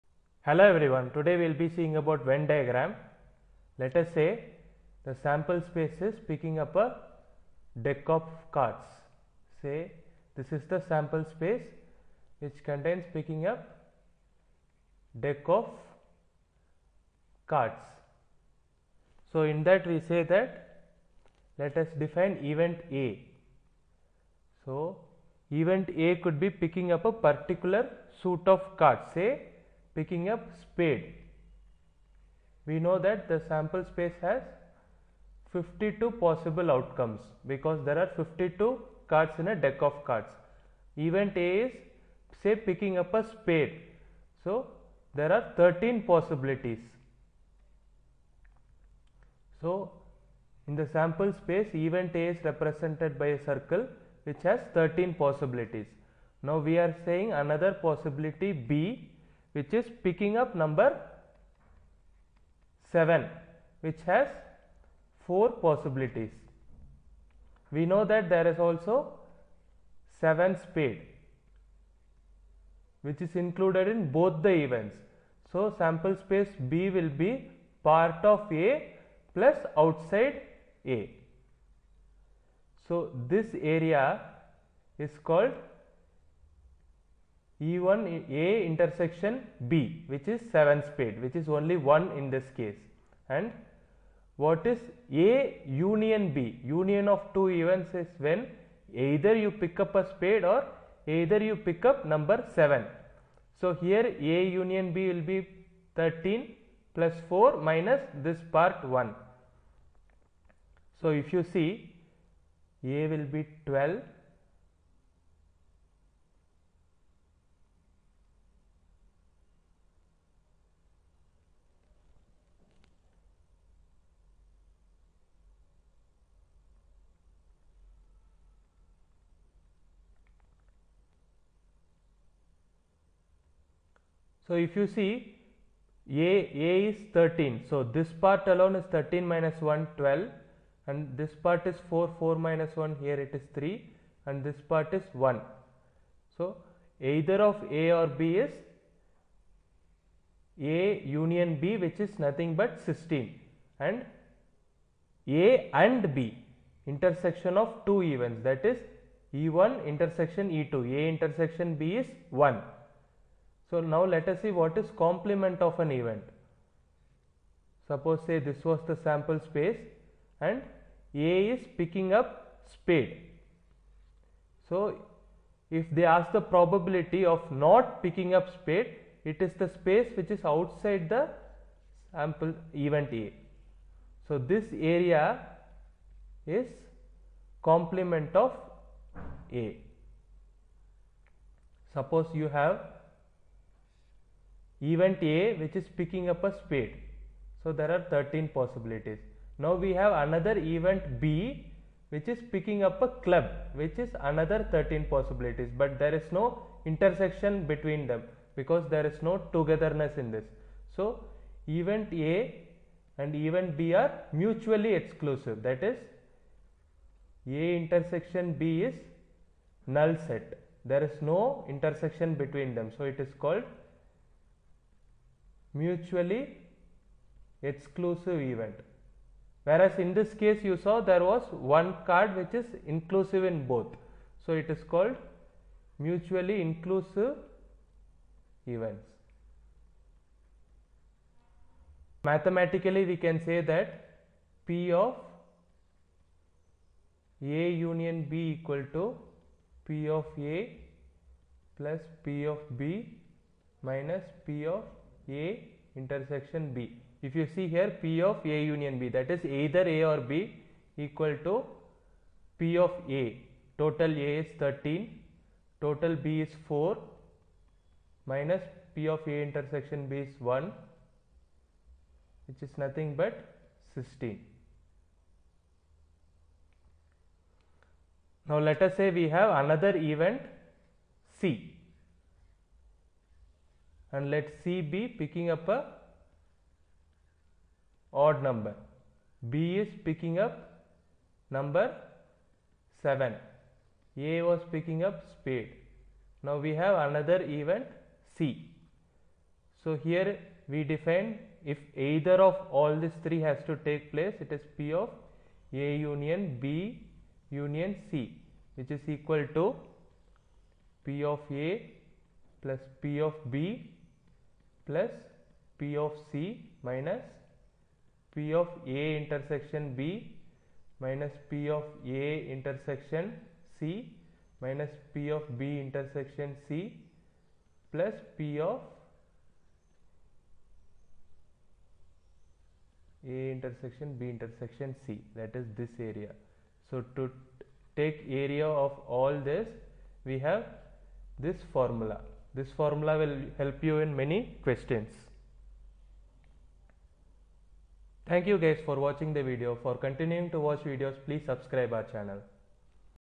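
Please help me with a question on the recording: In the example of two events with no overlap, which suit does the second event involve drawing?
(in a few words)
Club.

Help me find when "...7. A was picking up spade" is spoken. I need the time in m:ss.
4:53.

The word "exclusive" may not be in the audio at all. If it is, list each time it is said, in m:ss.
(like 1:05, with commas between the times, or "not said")
3:34, 3:47.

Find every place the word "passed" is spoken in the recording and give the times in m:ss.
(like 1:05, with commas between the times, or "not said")
not said.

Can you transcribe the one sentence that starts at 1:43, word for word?
So, here A union B will be 13 plus 4 minus this part 1.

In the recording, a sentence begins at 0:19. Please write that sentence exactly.
So, in that we say that let us define event A.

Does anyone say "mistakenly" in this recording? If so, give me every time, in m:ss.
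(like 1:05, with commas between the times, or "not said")
not said.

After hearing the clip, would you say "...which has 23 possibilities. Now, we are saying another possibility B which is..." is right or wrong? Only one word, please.
wrong.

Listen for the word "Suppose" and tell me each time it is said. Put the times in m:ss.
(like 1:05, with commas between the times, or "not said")
2:47, 3:11.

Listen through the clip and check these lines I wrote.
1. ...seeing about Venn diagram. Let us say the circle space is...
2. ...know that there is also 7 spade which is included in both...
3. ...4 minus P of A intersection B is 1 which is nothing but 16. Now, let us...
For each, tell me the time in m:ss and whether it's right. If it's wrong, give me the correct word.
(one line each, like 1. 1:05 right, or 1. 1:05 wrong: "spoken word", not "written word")
1. 0:01 wrong: "sample", not "circle"
2. 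1:07 right
3. 4:26 right.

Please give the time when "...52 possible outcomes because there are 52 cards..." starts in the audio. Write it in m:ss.
0:35.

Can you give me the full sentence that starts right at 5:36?
So, to take area of all this we have this formula this formula will help you in many questions.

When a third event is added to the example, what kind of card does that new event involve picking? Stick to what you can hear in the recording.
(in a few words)
Odd number.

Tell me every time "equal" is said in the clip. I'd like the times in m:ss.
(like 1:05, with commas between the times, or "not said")
4:08, 4:20, 5:09.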